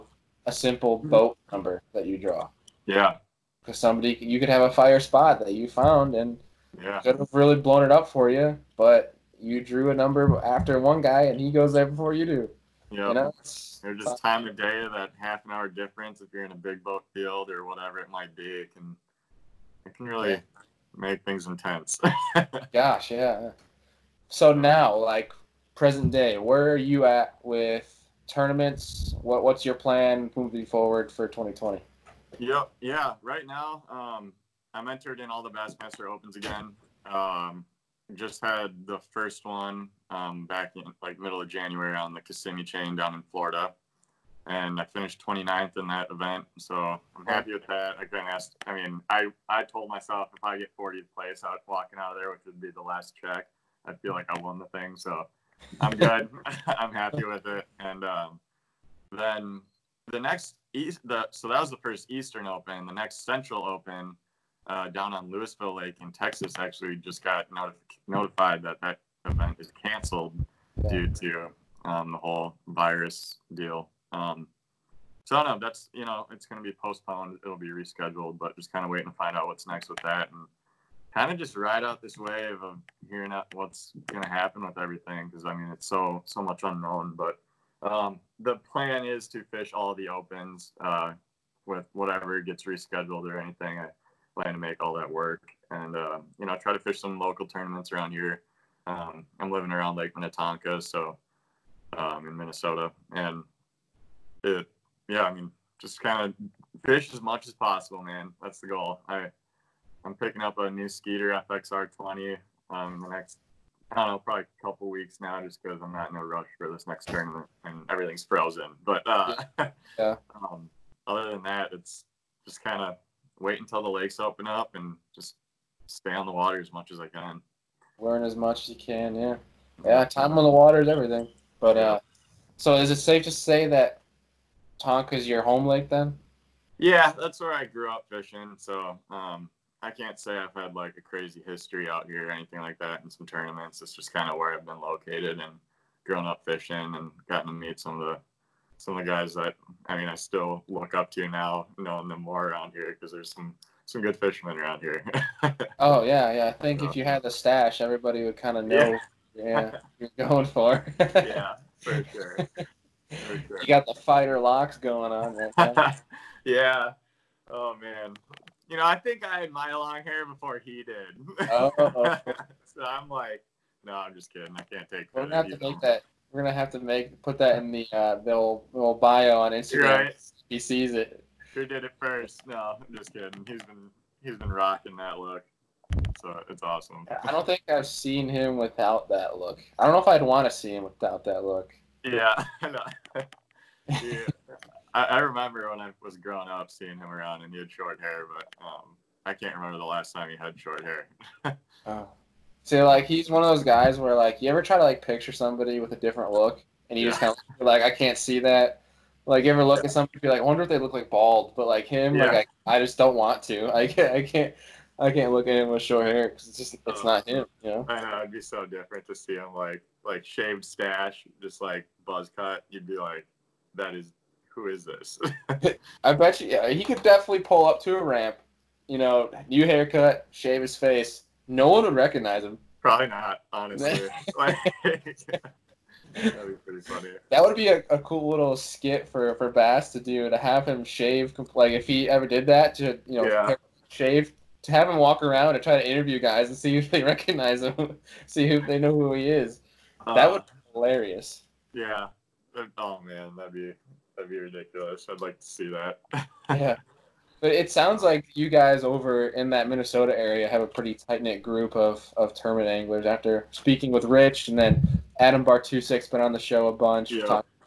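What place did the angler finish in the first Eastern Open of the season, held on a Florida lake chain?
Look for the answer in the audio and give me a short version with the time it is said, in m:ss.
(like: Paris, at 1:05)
29th, at 0:45.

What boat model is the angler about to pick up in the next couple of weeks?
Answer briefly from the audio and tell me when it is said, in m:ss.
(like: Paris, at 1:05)
Skeeter FXR 20, at 1:50.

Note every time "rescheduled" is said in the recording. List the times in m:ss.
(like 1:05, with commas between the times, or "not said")
1:17, 1:32.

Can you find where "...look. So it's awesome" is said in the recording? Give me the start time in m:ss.
3:05.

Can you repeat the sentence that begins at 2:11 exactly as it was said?
But uh, so is it safe to say that Tonka's your home lake then?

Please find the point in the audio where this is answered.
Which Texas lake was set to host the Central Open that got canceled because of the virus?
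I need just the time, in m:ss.
1:05.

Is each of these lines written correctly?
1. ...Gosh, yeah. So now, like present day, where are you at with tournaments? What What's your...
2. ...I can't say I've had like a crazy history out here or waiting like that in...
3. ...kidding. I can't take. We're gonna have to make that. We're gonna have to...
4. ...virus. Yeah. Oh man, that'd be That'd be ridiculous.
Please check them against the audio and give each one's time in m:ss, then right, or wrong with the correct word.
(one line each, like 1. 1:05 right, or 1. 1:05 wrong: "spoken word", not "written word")
1. 0:22 right
2. 2:19 wrong: "anything", not "waiting"
3. 2:54 right
4. 4:10 wrong: "hilarious", not "virus".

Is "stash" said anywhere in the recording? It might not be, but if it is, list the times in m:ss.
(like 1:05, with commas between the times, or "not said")
2:37, 3:40.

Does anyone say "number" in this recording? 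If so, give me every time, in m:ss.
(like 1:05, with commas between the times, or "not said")
0:01, 0:09.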